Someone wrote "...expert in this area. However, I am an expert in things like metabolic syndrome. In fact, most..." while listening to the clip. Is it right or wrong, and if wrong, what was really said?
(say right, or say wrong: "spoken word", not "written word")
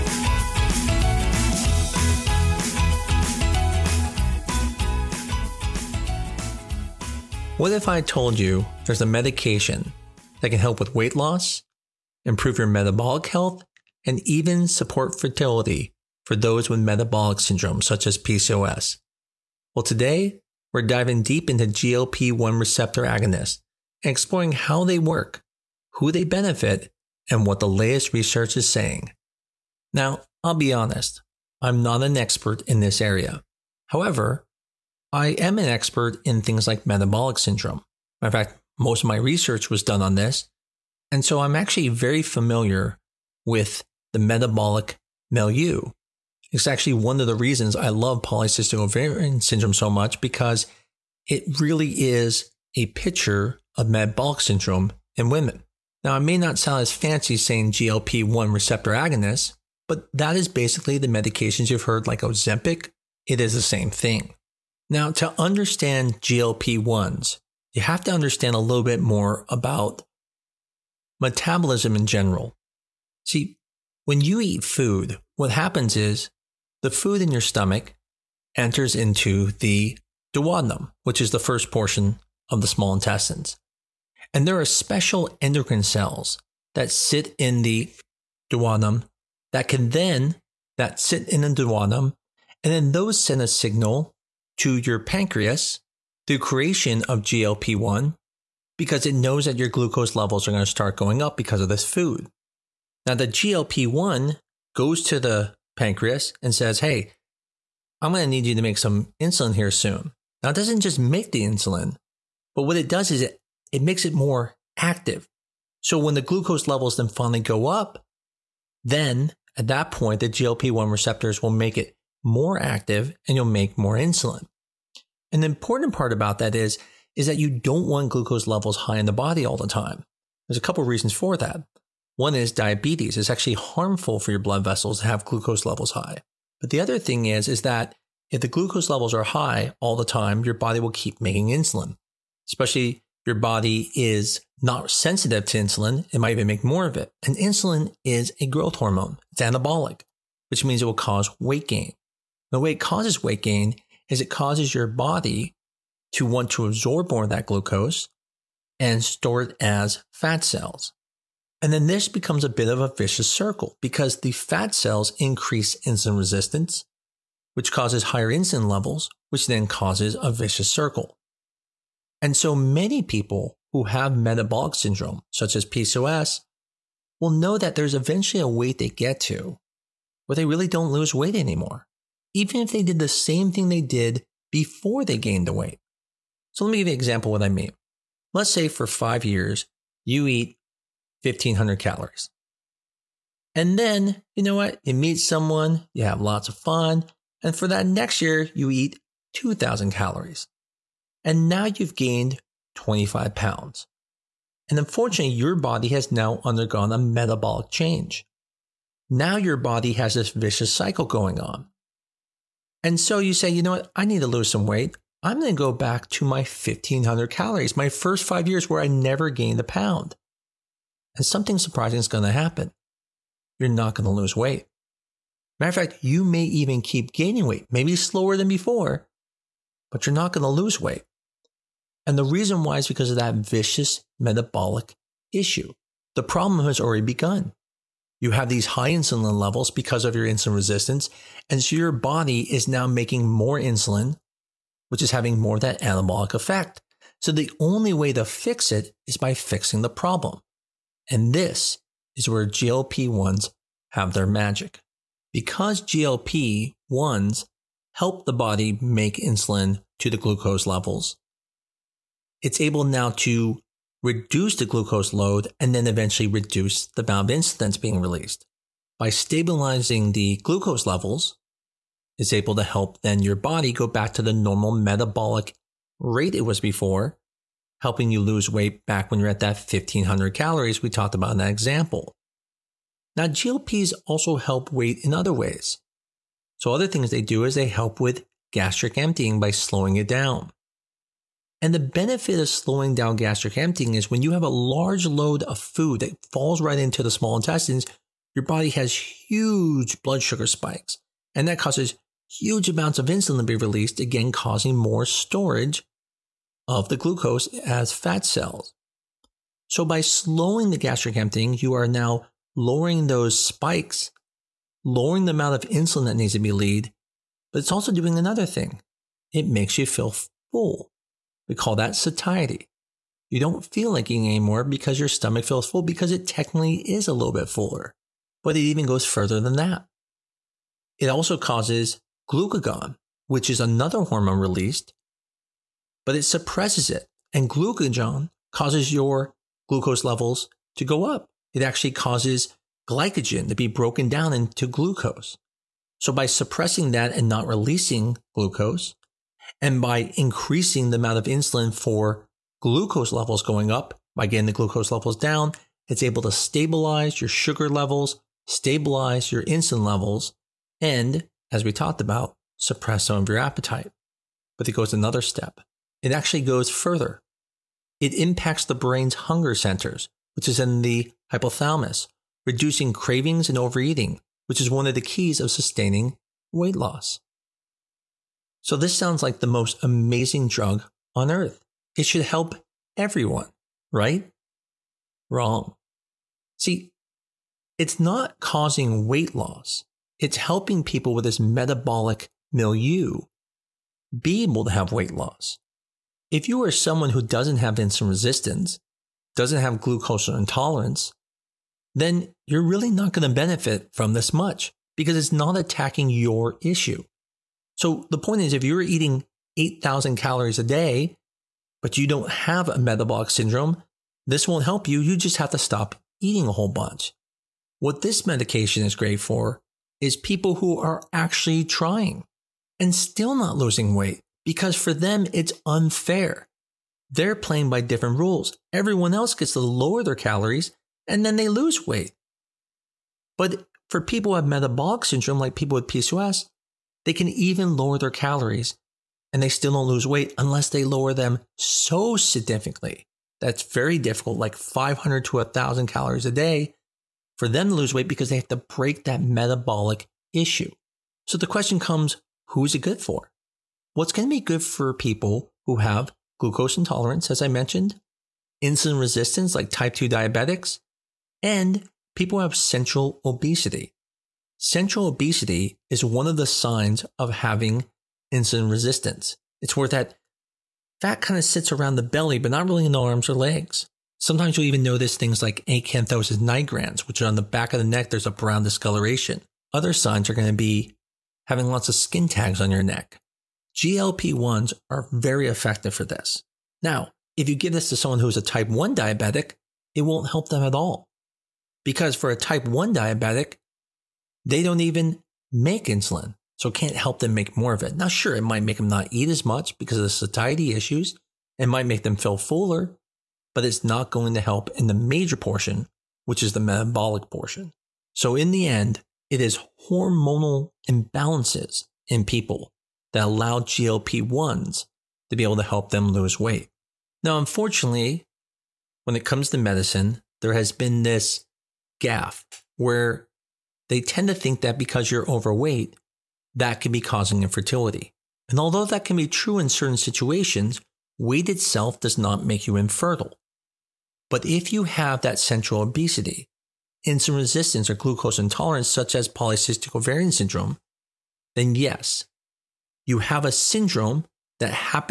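right.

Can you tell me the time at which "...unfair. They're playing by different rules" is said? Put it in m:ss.
7:05.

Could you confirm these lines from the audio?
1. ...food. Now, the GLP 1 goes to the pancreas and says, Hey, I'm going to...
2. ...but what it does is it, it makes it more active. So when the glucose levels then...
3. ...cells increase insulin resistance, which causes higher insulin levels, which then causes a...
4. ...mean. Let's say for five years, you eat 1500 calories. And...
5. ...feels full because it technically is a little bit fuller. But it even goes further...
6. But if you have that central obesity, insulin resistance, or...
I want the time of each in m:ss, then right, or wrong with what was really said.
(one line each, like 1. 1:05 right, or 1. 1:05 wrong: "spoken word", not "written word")
1. 1:41 right
2. 1:52 right
3. 2:44 right
4. 3:07 right
5. 5:25 right
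6. 8:54 right.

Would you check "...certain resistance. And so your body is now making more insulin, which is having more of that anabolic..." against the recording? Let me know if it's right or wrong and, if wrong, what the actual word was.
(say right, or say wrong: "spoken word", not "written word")
wrong: "insulin", not "certain".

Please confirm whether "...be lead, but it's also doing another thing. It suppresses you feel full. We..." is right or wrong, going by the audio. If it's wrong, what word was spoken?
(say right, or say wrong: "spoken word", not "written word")
wrong: "makes", not "suppresses".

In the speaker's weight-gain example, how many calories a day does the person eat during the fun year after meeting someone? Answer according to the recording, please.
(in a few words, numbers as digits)
2000 calories.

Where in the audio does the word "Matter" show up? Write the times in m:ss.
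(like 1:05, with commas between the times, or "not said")
3:45.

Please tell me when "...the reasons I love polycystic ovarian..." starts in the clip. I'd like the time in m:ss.
0:47.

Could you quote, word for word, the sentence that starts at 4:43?
Now, GLPs also help weight in other ways.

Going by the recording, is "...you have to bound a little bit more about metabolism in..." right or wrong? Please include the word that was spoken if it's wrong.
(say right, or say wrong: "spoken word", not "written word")
wrong: "understand", not "bound".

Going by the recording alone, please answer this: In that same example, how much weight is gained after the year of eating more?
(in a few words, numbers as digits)
25 pounds.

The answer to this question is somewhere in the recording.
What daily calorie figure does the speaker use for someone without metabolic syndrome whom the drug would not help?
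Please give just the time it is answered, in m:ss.
6:49.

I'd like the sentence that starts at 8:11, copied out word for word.
Because for a type 1 diabetic, they don't even make insulin, so it can't help them make more of it.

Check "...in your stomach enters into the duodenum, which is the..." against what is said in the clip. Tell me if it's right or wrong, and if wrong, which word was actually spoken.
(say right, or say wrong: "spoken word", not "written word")
right.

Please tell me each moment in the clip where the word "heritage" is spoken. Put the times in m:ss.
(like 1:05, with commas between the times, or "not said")
not said.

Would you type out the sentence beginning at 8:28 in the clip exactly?
So, in the end, it is hormonal imbalances in people that allow GLP 1s to be able to help them lose weight.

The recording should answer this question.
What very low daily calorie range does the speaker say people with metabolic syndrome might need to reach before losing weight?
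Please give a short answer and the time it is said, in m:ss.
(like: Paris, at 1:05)
500 to 1,000 calories, at 7:24.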